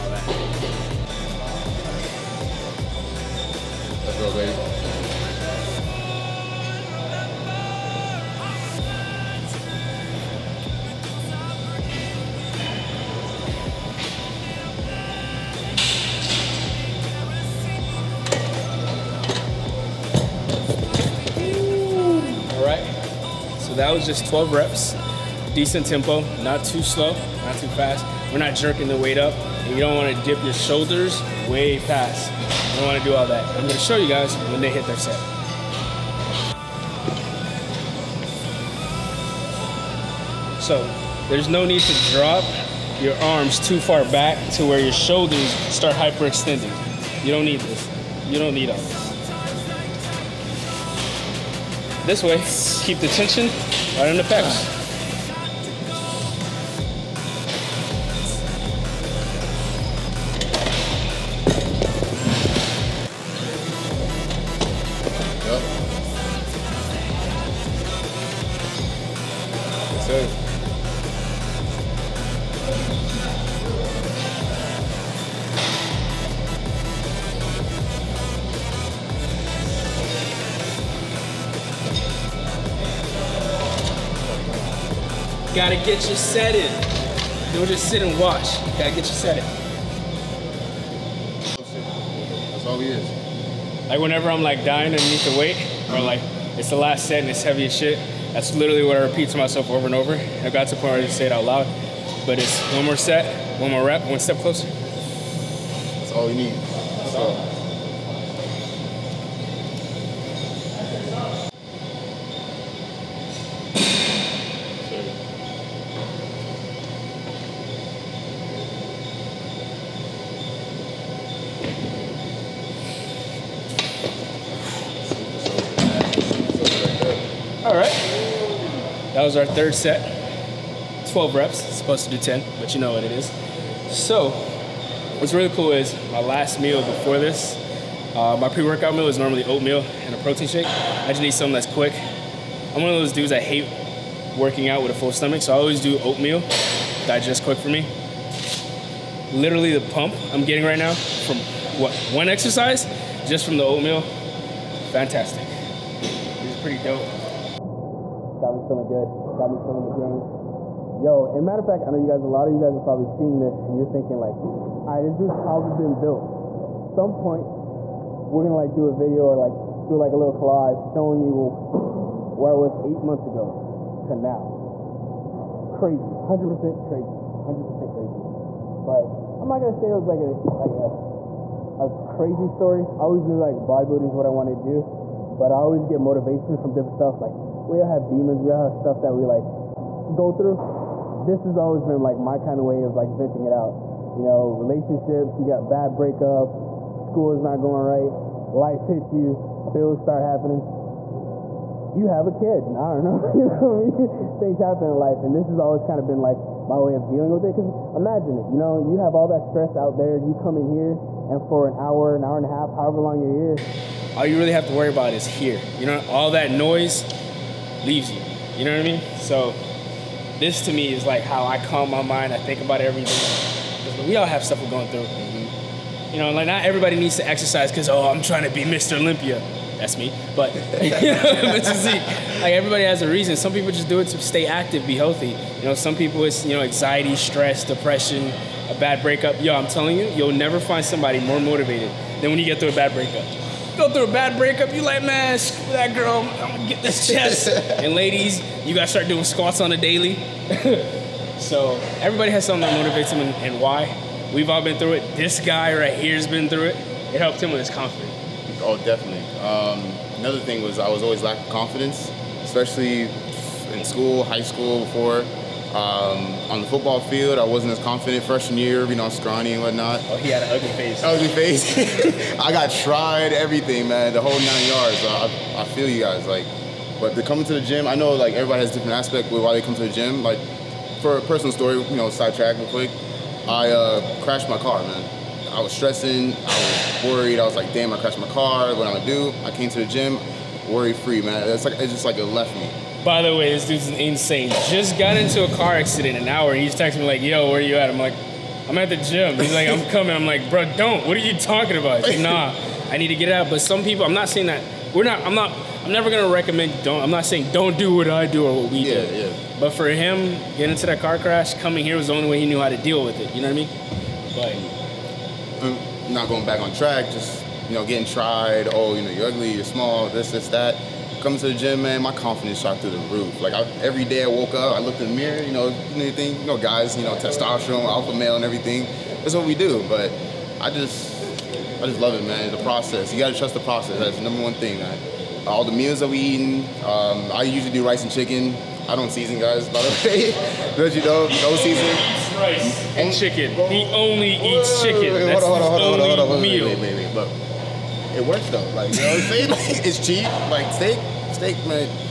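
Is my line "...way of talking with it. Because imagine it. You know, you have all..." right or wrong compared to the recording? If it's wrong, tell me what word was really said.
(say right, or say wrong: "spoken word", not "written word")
wrong: "dealing", not "talking".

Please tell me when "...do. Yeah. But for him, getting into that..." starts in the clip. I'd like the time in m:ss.
5:09.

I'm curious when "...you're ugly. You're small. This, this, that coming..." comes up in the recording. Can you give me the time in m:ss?
5:19.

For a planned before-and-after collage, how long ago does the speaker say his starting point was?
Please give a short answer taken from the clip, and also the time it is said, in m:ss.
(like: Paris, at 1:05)
8 months, at 2:52.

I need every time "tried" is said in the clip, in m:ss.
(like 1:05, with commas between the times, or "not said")
4:32, 5:18.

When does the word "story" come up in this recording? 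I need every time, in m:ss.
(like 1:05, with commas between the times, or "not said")
3:02, 4:41.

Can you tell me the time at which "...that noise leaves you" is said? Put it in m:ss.
3:36.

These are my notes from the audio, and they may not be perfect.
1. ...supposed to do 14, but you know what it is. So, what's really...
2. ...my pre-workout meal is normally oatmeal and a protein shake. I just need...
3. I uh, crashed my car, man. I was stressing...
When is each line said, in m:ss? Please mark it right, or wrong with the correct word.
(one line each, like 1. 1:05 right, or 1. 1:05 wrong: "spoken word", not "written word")
1. 2:11 wrong: "10", not "14"
2. 2:18 right
3. 4:43 right.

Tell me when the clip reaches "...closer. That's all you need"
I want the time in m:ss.
1:44.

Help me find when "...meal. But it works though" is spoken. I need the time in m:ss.
5:46.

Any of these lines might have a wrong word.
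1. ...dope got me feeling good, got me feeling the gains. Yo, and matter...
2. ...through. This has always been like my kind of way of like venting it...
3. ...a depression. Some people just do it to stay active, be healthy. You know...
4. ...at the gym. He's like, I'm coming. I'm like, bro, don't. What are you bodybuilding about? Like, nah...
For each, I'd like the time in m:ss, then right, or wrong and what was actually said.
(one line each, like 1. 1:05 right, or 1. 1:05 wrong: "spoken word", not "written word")
1. 2:36 right
2. 3:10 right
3. 3:53 wrong: "reason", not "depression"
4. 4:58 wrong: "talking", not "bodybuilding".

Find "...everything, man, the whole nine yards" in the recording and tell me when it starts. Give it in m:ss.
4:33.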